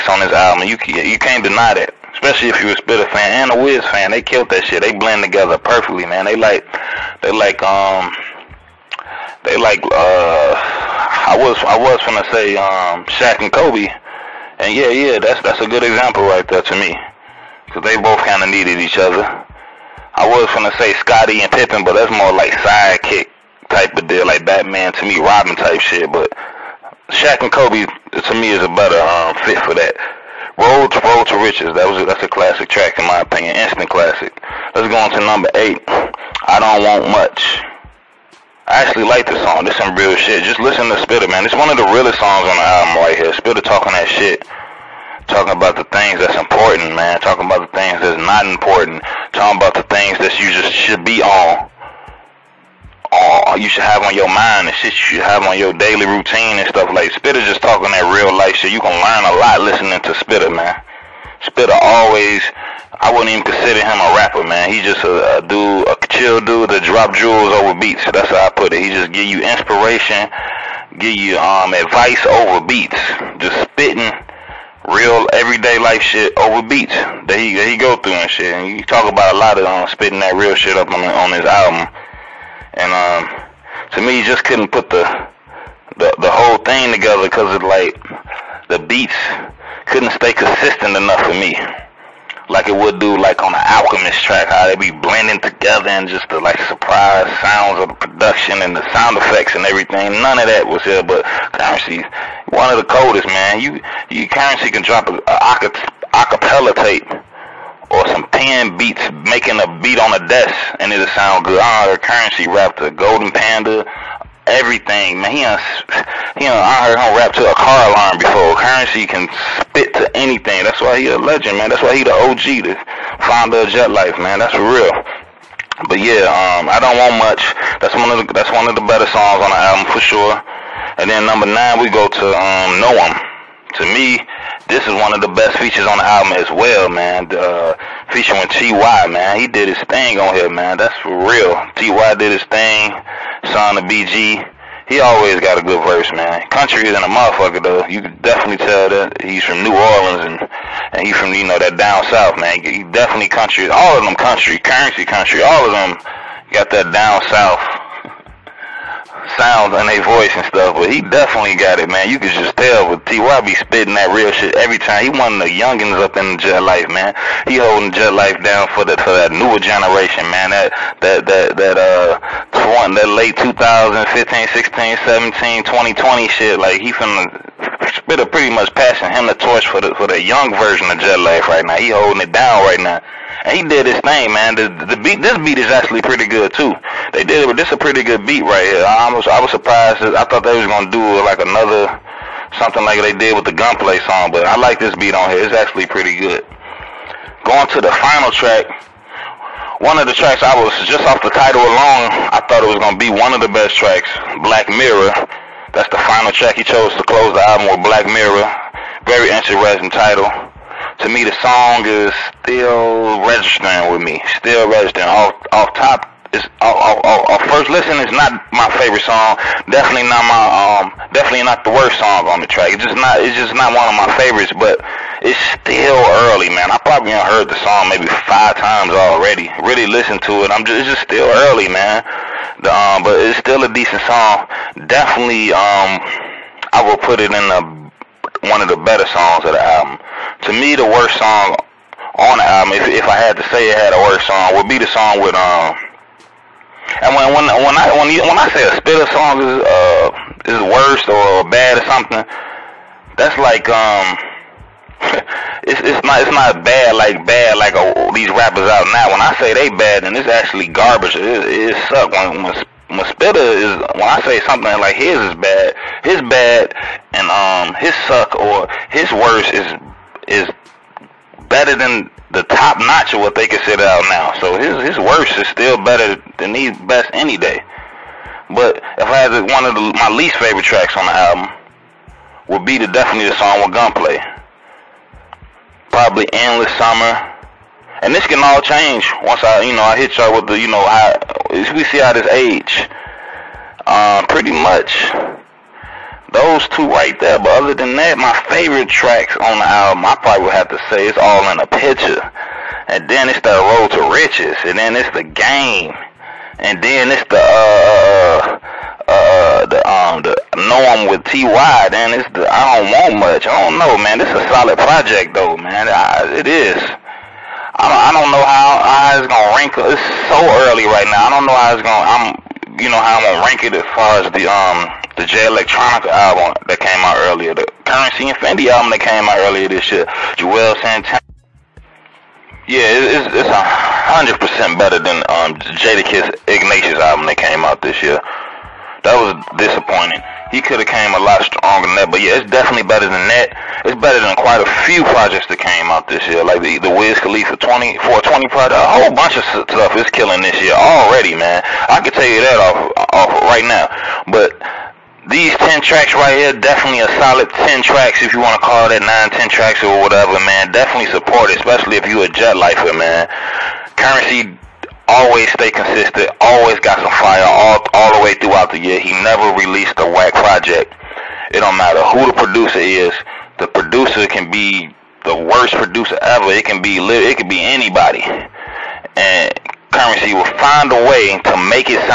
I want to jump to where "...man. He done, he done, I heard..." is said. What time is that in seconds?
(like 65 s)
115 s.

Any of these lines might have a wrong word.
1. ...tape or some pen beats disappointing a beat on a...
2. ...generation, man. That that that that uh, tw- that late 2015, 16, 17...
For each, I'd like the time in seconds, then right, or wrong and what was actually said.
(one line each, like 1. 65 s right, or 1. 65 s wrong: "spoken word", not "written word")
1. 106 s wrong: "making", not "disappointing"
2. 169 s right.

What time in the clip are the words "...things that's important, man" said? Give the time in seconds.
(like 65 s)
45 s.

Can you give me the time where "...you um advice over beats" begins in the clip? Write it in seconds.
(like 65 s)
71 s.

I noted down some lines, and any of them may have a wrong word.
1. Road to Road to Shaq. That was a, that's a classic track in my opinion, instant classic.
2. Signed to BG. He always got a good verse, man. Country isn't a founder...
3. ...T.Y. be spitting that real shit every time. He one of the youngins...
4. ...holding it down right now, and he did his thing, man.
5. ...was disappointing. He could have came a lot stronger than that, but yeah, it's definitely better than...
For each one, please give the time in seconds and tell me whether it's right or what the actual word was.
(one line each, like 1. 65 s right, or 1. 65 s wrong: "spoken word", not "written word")
1. 30 s wrong: "Riches", not "Shaq"
2. 143 s wrong: "motherfucker", not "founder"
3. 163 s right
4. 181 s right
5. 339 s right.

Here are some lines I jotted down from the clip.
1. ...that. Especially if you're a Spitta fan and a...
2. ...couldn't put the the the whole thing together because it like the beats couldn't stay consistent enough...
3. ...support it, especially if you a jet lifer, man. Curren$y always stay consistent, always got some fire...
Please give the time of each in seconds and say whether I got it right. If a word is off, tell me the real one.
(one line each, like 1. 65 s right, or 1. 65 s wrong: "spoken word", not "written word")
1. 1 s right
2. 84 s right
3. 361 s right.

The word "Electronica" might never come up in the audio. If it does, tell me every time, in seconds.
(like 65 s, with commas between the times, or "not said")
325 s.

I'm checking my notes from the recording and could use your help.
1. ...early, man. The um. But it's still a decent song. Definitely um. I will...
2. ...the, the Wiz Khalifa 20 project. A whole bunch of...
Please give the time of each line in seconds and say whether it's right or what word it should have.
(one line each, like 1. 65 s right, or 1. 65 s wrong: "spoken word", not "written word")
1. 231 s right
2. 346 s right.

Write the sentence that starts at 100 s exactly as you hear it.
None of that was here, but Curren$y, one of the coldest man.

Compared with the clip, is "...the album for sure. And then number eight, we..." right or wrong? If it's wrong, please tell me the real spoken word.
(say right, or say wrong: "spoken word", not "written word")
wrong: "nine", not "eight".